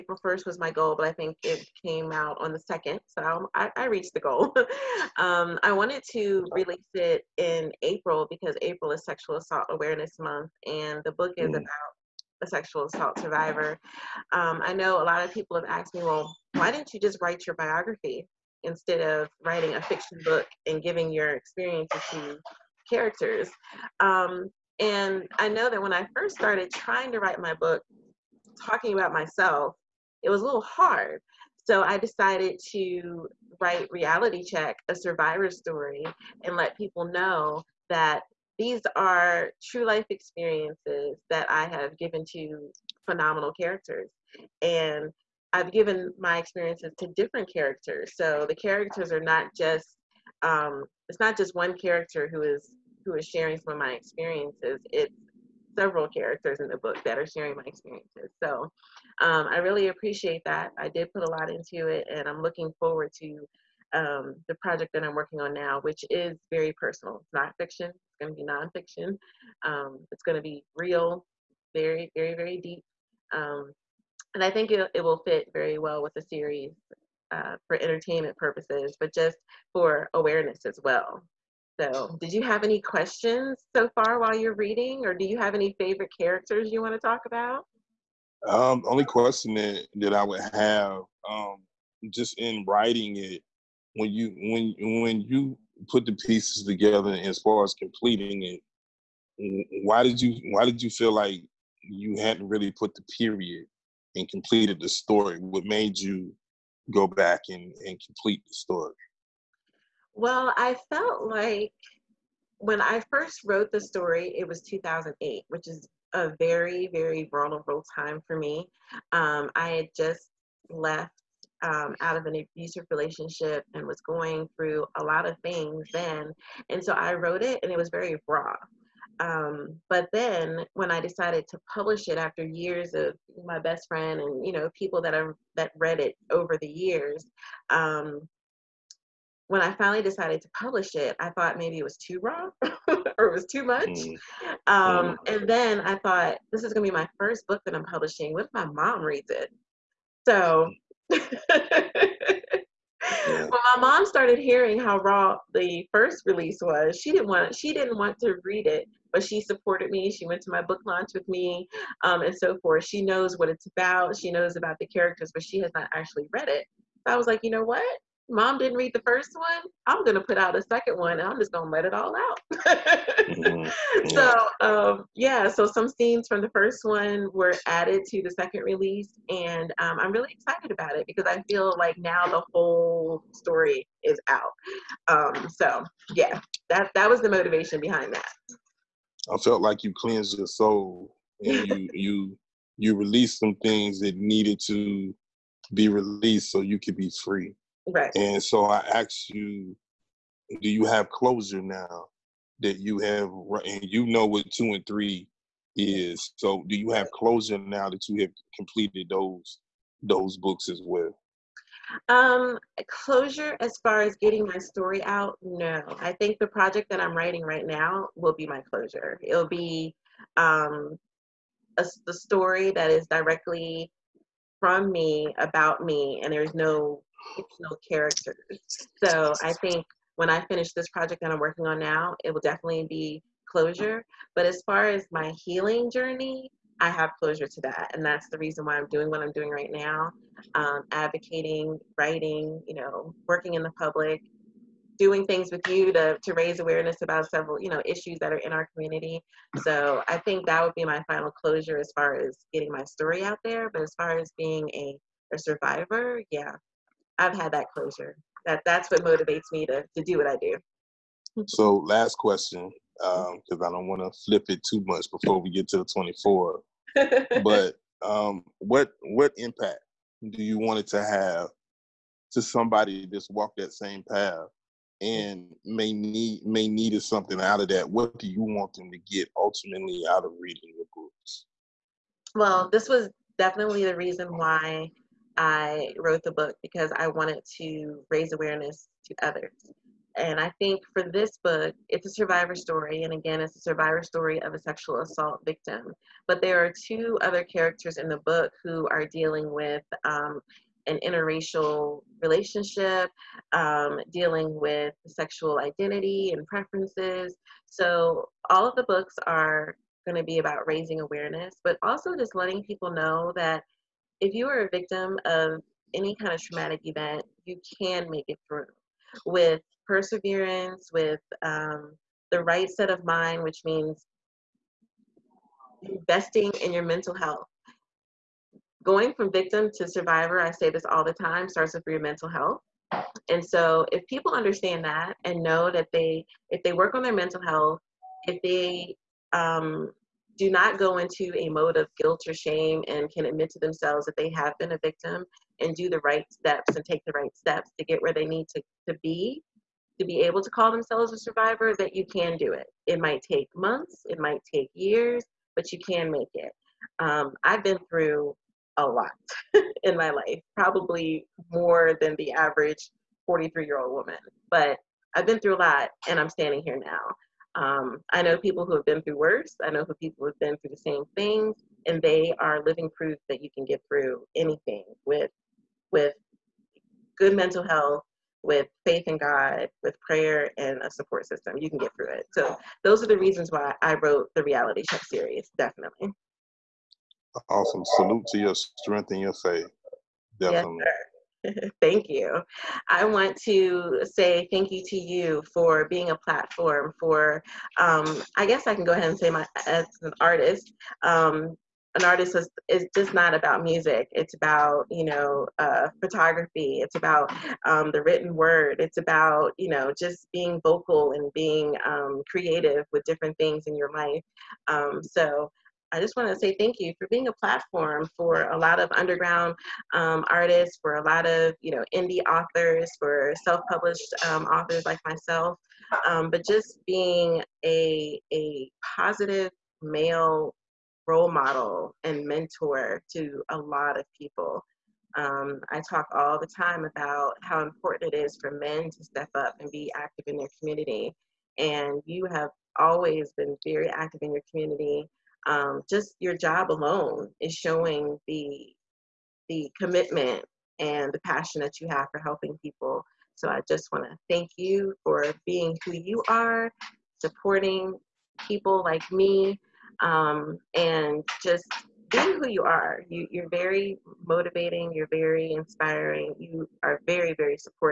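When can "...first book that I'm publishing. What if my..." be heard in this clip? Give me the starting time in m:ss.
2:27.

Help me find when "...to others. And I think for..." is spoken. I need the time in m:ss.
4:49.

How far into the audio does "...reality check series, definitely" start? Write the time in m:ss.
6:24.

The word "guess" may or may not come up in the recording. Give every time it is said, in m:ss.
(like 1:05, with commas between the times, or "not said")
6:38.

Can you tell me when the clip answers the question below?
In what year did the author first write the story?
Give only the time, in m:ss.
1:54.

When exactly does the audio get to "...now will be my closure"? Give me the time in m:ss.
3:37.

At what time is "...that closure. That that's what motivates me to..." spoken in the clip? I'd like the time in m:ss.
4:17.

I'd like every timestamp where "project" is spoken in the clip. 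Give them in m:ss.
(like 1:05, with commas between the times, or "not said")
1:04, 3:36, 3:50.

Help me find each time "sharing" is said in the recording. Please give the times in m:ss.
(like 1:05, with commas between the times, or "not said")
0:53, 0:57.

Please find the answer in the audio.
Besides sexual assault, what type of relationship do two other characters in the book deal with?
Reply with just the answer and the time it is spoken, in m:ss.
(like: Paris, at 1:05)
Interracial relationship, at 5:00.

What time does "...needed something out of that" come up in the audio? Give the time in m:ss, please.
4:36.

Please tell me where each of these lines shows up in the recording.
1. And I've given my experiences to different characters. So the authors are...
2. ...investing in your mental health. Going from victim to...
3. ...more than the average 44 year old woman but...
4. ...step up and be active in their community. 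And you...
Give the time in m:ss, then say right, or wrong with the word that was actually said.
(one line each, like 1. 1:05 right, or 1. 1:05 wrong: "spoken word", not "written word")
1. 0:44 wrong: "characters", not "authors"
2. 5:25 right
3. 6:01 wrong: "43", not "44"
4. 7:19 right.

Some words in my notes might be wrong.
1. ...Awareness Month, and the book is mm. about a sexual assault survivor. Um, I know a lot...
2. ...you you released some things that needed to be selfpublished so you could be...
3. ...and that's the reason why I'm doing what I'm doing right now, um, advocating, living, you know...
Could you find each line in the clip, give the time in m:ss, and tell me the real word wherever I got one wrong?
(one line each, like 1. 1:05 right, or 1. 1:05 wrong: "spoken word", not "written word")
1. 0:09 right
2. 3:11 wrong: "released", not "selfpublished"
3. 3:57 wrong: "writing", not "living".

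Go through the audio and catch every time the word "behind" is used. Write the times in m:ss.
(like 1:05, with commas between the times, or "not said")
3:07.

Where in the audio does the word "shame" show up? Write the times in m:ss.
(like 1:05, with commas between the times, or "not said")
5:42.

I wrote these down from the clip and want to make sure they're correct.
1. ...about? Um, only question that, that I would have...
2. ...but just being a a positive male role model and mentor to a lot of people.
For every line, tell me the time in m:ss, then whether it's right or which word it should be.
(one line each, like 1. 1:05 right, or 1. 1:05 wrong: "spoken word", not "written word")
1. 1:27 right
2. 7:06 right.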